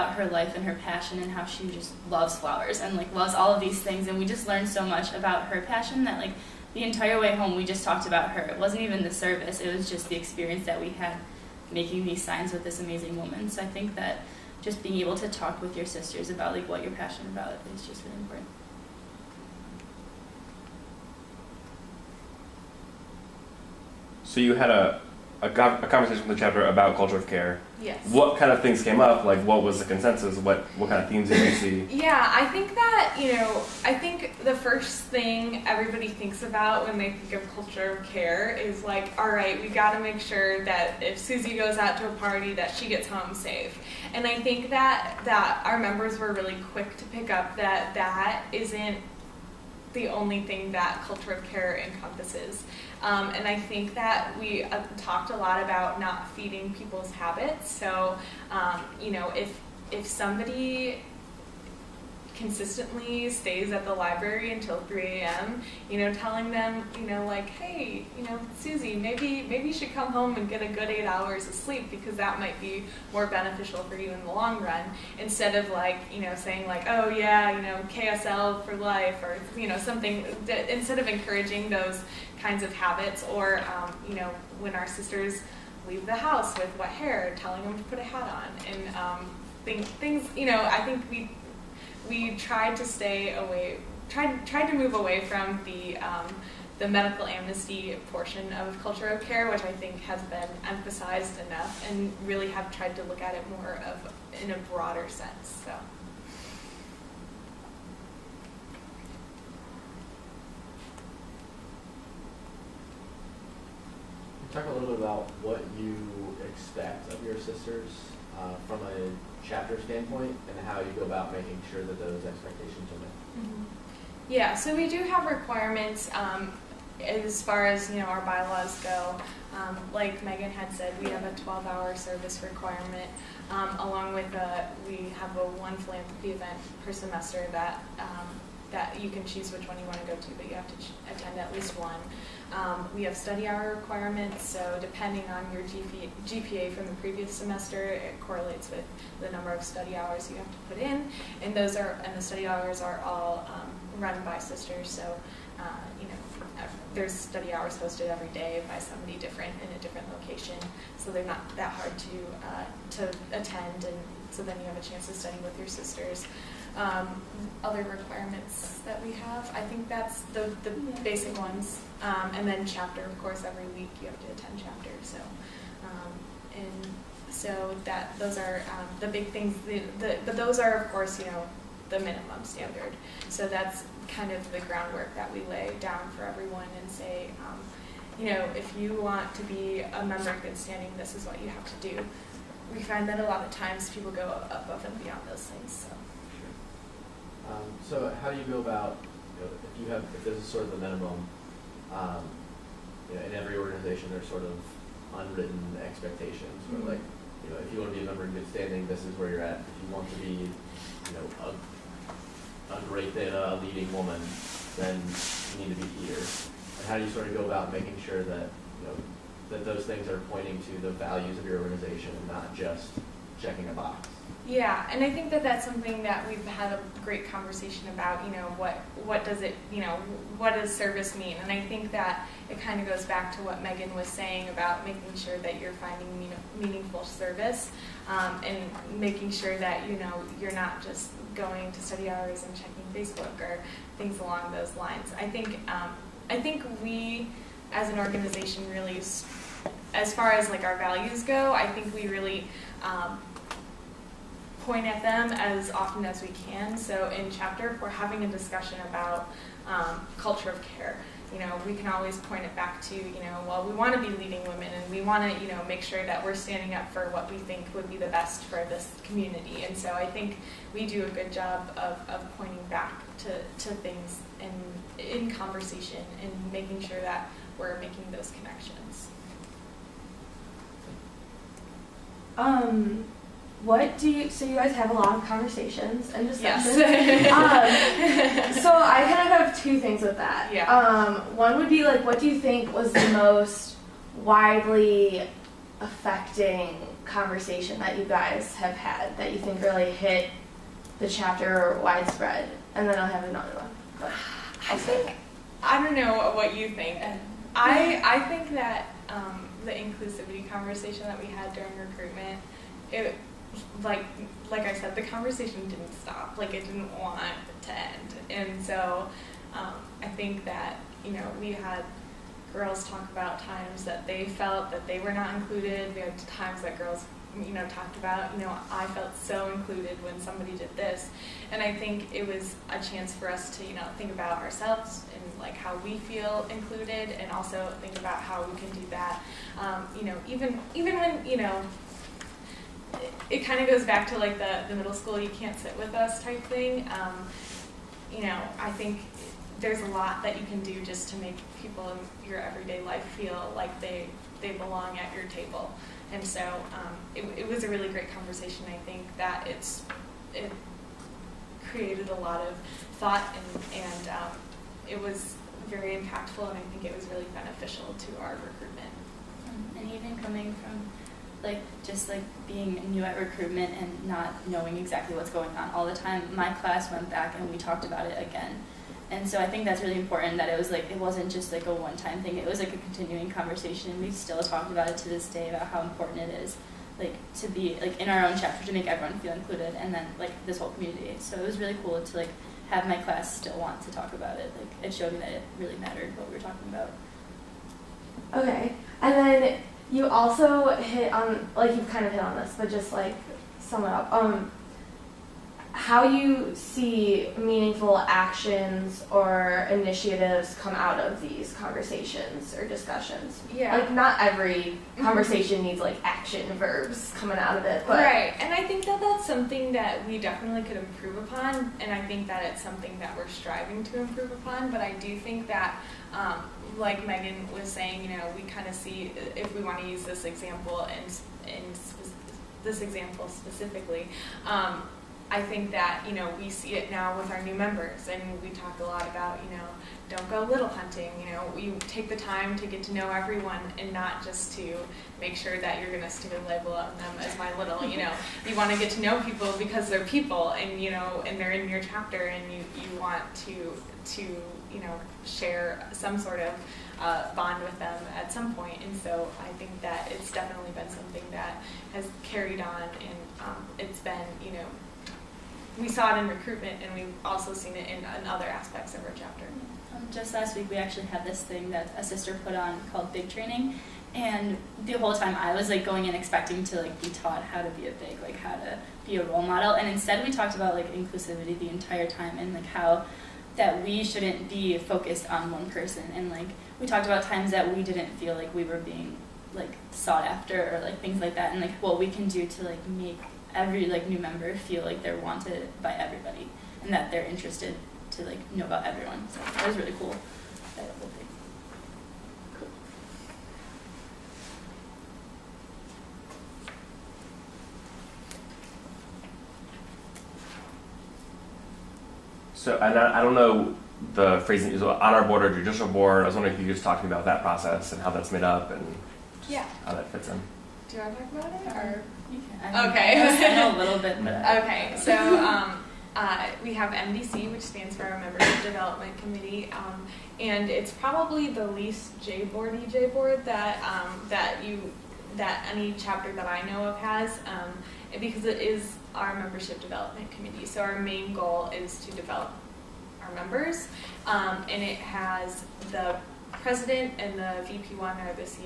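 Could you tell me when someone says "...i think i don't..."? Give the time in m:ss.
5:04.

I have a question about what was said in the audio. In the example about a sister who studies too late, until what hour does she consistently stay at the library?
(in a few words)
3 a.m.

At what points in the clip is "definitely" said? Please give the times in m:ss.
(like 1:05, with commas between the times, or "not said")
7:00, 7:40.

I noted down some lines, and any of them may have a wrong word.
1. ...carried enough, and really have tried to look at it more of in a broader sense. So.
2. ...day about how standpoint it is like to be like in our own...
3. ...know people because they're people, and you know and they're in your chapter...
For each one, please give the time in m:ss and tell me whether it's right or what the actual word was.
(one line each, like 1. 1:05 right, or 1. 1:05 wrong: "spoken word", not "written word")
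1. 1:40 wrong: "emphasized", not "carried"
2. 6:25 wrong: "important", not "standpoint"
3. 7:29 right.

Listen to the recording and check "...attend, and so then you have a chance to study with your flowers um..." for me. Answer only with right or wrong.
wrong.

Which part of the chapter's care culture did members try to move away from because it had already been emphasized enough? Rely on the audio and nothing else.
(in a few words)
Medical amnesty.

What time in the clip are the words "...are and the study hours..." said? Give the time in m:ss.
2:31.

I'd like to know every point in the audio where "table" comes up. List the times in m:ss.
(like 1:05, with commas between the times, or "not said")
5:55.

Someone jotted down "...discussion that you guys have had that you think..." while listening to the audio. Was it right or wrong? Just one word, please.
wrong.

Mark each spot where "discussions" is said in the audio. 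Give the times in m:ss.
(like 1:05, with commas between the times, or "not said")
4:18, 4:46, 6:52.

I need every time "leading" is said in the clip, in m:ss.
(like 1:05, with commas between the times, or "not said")
3:33, 4:24.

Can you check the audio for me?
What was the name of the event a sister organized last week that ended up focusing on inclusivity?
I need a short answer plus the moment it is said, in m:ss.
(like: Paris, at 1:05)
Big Training, at 7:53.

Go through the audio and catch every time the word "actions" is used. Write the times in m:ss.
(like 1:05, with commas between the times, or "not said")
6:47, 6:56.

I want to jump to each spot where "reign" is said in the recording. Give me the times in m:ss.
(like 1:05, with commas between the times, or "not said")
not said.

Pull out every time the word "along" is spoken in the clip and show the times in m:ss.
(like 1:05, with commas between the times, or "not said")
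2:13, 4:04.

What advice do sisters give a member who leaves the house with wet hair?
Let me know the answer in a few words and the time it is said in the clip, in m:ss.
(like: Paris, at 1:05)
Put a hat on, at 1:27.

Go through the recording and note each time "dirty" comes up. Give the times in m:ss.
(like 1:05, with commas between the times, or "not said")
not said.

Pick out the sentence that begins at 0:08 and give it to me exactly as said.
It wasn't even the service; it was just the experience that we had making these signs with this amazing woman.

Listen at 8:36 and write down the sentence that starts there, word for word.
I was wondering if you could just talk to me about that process and how that's made up and yeah.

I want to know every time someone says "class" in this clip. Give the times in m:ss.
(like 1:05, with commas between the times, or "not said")
6:16, 6:32.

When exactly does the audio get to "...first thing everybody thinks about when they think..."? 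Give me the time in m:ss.
0:34.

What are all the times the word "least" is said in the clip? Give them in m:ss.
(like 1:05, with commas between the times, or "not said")
2:21, 8:51.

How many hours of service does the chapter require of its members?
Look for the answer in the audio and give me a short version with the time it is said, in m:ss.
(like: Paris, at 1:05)
12, at 2:11.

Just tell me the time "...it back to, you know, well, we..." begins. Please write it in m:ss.
4:22.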